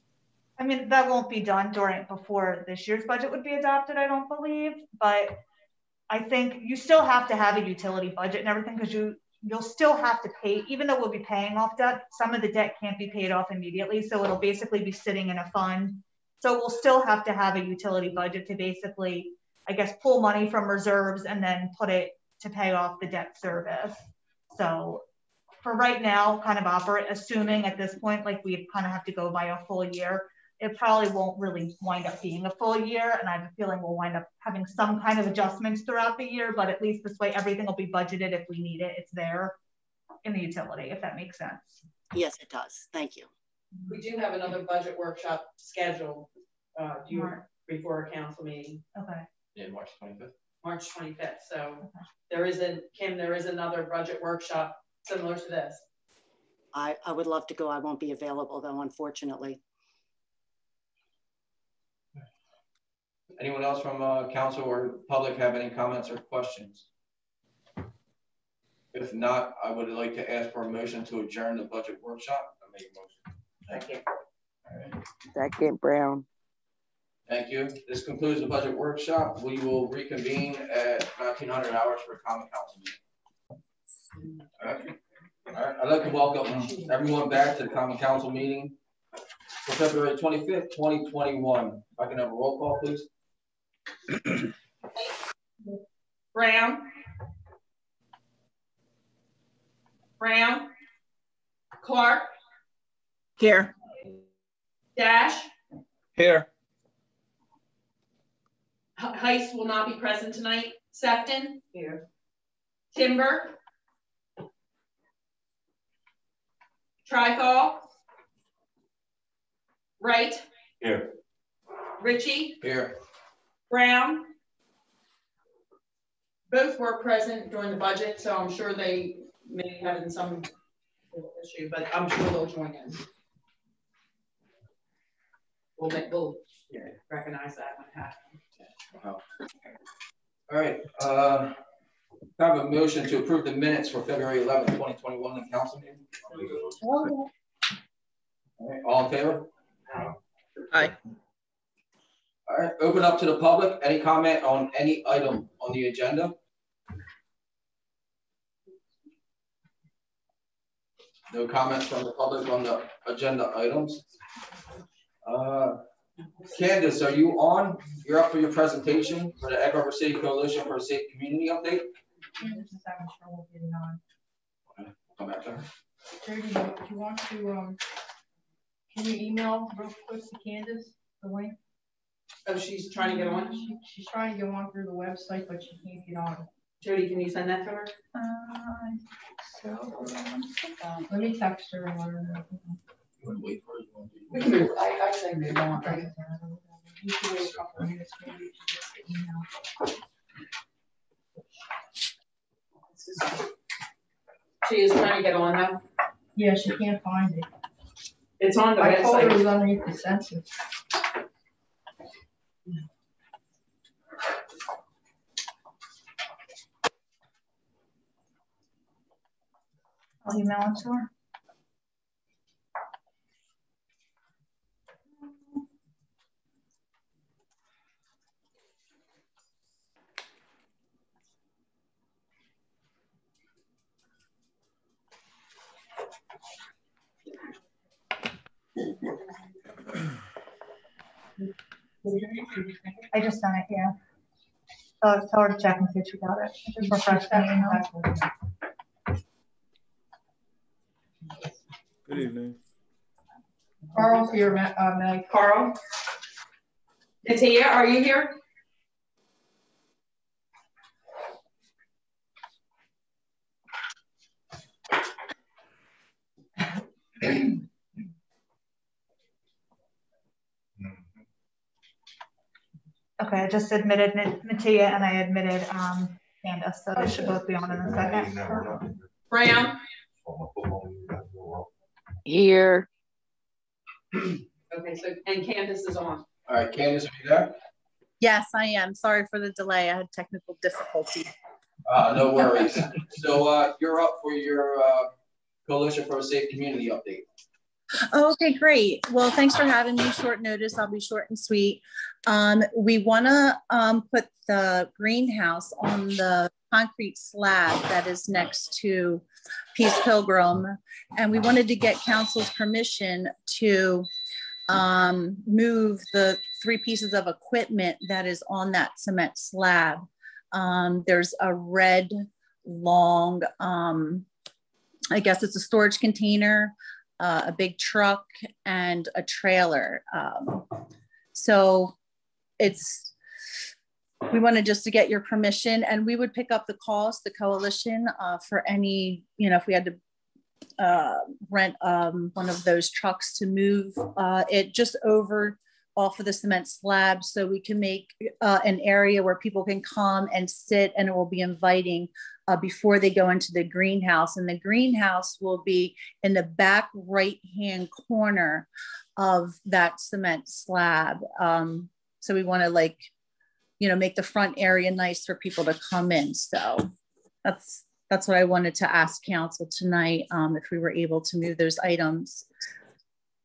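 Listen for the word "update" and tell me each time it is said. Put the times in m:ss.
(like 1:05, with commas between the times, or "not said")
2:51, 4:56.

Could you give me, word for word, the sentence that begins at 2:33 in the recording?
Any comment on any item on the agenda?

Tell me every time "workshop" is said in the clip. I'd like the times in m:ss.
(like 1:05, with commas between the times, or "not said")
0:44, 0:54, 1:12, 1:18.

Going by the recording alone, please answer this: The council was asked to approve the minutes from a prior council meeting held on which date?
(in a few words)
February 11, 2021.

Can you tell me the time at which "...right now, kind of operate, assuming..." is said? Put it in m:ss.
0:25.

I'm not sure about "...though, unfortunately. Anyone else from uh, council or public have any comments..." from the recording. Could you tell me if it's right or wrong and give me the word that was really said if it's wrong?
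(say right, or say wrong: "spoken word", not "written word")
right.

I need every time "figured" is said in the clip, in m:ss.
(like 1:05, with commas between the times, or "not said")
not said.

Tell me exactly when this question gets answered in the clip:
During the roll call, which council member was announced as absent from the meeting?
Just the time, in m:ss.
1:48.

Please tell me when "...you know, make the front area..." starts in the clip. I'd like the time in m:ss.
6:03.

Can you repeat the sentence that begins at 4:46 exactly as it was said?
All right, Candace, are you there?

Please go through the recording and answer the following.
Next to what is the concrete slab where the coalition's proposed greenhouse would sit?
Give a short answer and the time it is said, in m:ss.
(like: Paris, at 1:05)
Peace Pilgrim, at 5:09.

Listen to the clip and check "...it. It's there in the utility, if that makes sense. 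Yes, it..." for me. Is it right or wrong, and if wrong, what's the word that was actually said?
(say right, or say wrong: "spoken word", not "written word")
right.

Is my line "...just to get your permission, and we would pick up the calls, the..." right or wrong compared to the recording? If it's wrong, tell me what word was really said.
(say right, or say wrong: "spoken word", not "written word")
right.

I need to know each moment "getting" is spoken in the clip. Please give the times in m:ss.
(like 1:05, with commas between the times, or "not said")
2:53.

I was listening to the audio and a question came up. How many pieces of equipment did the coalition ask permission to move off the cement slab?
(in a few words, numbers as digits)
3.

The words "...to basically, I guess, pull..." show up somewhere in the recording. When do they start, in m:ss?
0:18.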